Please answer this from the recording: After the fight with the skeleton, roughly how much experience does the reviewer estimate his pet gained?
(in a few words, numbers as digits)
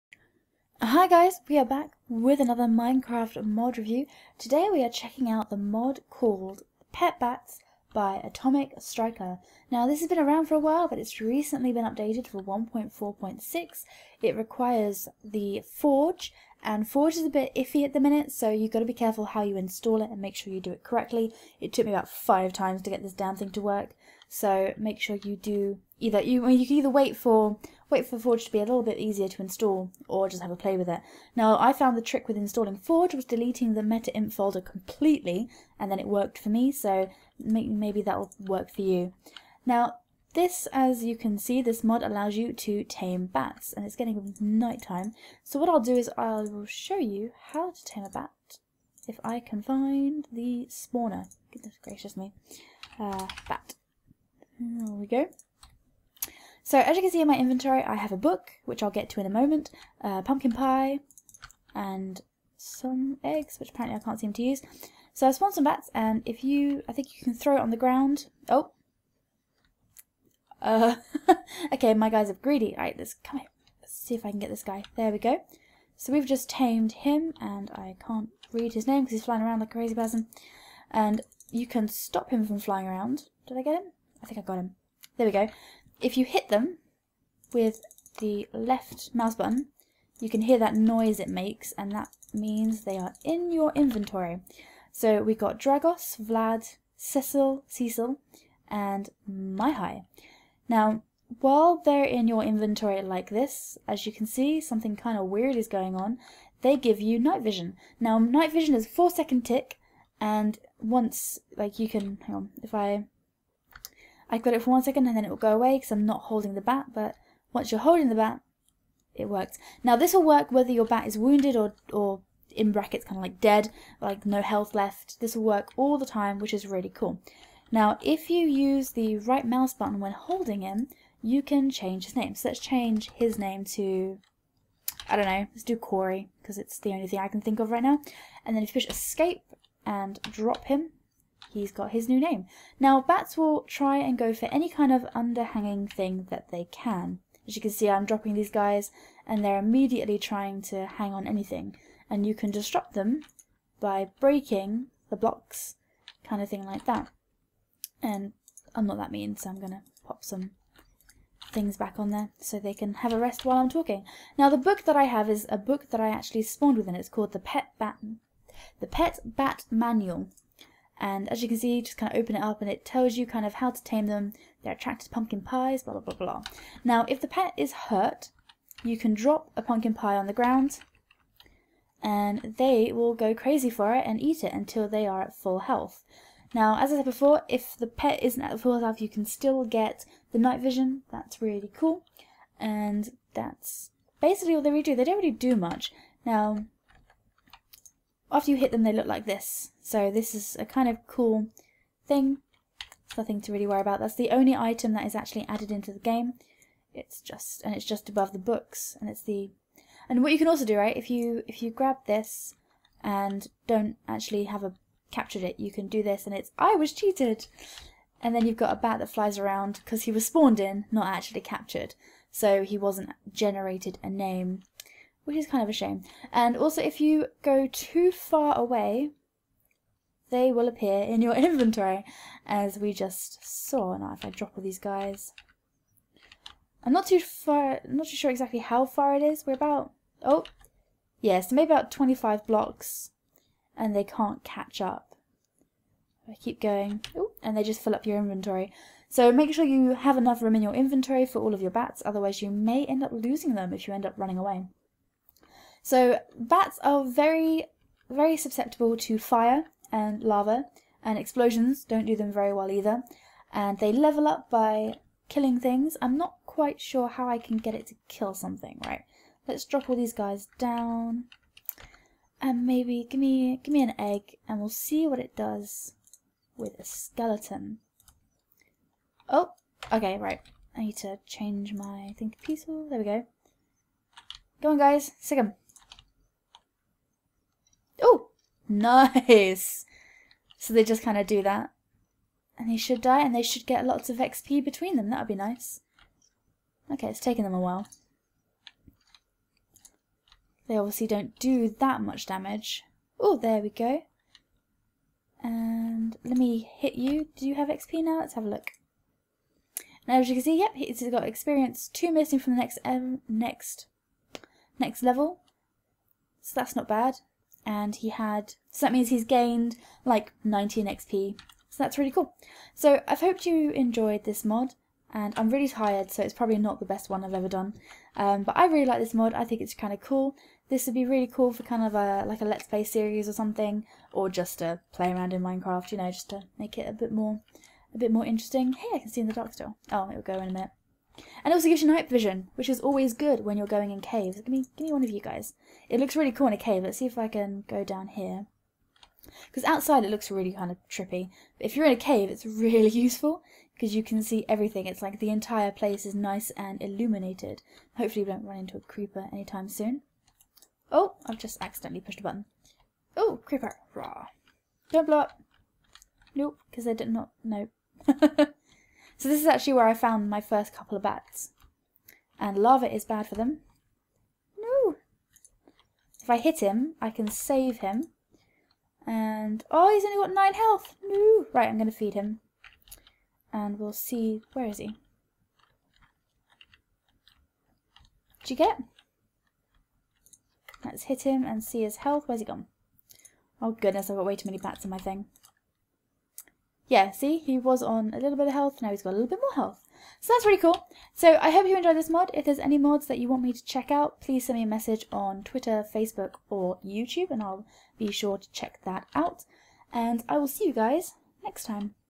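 19.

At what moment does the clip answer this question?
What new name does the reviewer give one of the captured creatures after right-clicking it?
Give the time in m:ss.
2:15.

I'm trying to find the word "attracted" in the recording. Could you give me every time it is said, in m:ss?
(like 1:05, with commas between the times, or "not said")
2:54.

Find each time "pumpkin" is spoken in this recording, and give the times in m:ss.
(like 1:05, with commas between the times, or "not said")
1:00, 2:55, 2:59.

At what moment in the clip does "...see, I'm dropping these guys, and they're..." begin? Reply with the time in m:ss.
2:27.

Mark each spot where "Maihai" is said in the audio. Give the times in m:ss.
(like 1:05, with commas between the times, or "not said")
1:39.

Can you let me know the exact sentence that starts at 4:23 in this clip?
And they level up by killing things.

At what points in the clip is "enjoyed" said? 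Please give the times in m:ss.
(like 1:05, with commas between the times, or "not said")
5:23, 6:41.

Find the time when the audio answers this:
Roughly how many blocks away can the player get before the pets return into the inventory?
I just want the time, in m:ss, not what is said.
4:01.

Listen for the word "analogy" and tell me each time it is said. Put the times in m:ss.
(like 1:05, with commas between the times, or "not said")
not said.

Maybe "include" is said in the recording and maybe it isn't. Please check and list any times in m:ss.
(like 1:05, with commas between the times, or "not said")
not said.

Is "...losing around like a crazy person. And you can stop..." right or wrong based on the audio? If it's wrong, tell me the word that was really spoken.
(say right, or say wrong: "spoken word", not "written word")
wrong: "flying", not "losing".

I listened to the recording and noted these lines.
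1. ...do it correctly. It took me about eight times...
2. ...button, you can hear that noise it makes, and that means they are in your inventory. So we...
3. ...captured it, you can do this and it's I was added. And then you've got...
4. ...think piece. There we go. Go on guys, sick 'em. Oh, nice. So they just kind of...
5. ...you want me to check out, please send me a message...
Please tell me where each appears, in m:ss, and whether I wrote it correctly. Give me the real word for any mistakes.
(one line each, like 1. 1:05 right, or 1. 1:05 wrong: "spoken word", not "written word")
1. 0:20 wrong: "five", not "eight"
2. 1:29 right
3. 3:35 wrong: "cheated", not "added"
4. 4:42 right
5. 6:43 right.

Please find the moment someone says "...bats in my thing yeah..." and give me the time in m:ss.
6:34.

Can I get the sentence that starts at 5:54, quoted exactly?
It's like the entire place is nice and illuminated.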